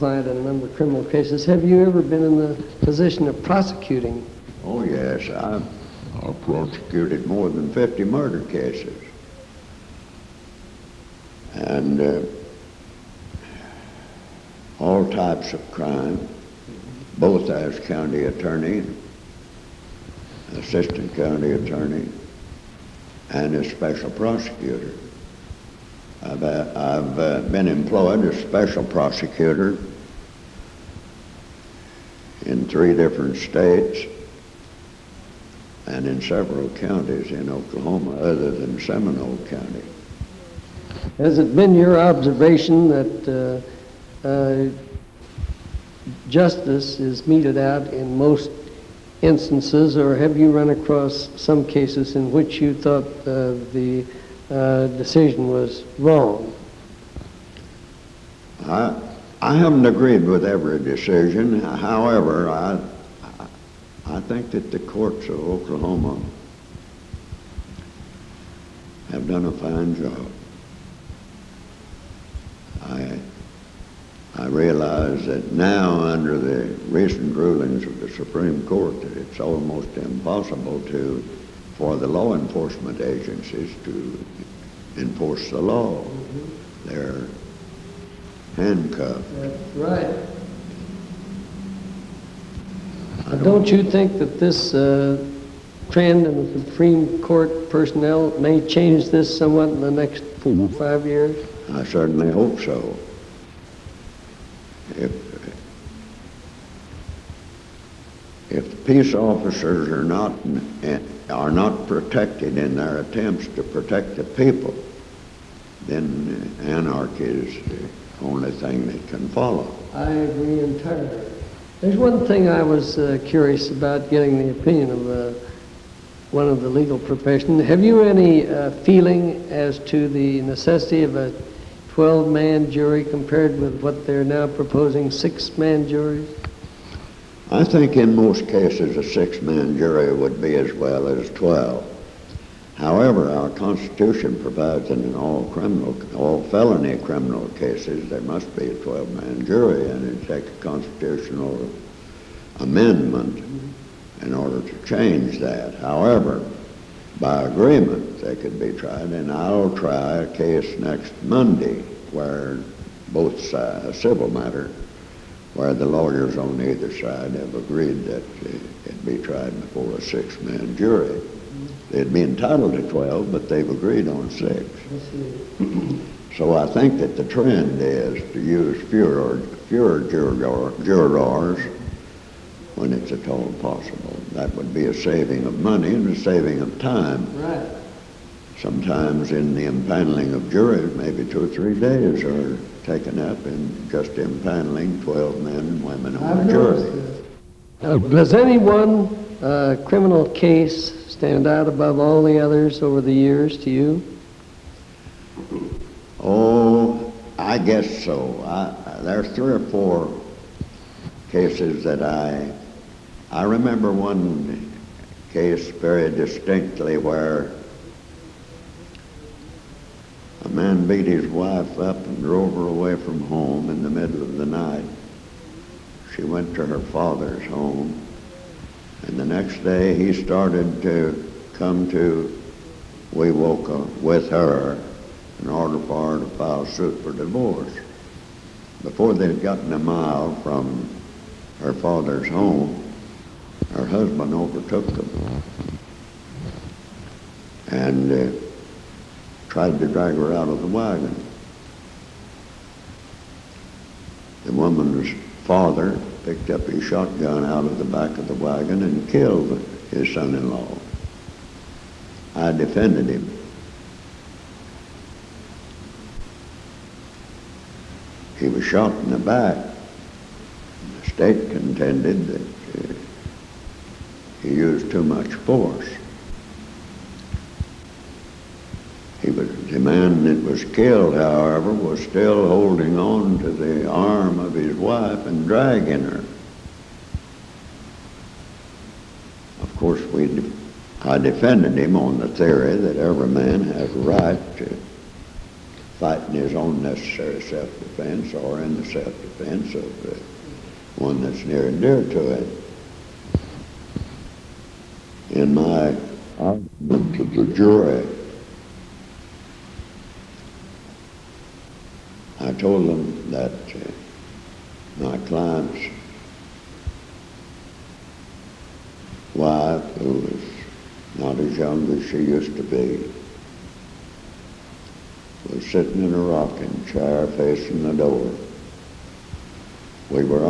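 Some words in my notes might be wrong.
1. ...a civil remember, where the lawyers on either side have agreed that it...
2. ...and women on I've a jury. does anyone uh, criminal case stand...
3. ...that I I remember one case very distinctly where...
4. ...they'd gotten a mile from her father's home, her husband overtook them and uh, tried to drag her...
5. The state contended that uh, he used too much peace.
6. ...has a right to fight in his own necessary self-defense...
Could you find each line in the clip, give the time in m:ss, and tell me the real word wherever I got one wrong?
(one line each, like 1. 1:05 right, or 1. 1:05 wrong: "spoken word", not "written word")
1. 2:43 wrong: "matter", not "remember"
2. 3:15 right
3. 3:31 right
4. 3:59 right
5. 4:31 wrong: "force", not "peace"
6. 4:53 right.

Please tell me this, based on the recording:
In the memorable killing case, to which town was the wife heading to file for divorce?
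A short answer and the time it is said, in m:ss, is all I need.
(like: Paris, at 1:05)
Wewoka, at 3:53.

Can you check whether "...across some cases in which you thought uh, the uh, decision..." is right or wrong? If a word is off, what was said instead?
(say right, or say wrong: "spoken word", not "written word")
right.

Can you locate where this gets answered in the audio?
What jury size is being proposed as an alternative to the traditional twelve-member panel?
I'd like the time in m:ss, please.
2:15.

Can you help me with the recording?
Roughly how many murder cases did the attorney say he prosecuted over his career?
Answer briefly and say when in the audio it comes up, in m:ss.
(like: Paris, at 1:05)
More than 50, at 0:07.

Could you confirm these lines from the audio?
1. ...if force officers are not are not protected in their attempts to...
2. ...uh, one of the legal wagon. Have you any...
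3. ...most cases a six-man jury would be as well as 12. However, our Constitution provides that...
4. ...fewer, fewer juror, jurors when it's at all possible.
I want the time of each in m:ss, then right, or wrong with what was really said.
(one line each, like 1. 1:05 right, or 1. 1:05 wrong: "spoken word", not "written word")
1. 1:48 wrong: "peace", not "force"
2. 2:05 wrong: "profession", not "wagon"
3. 2:18 right
4. 2:58 right.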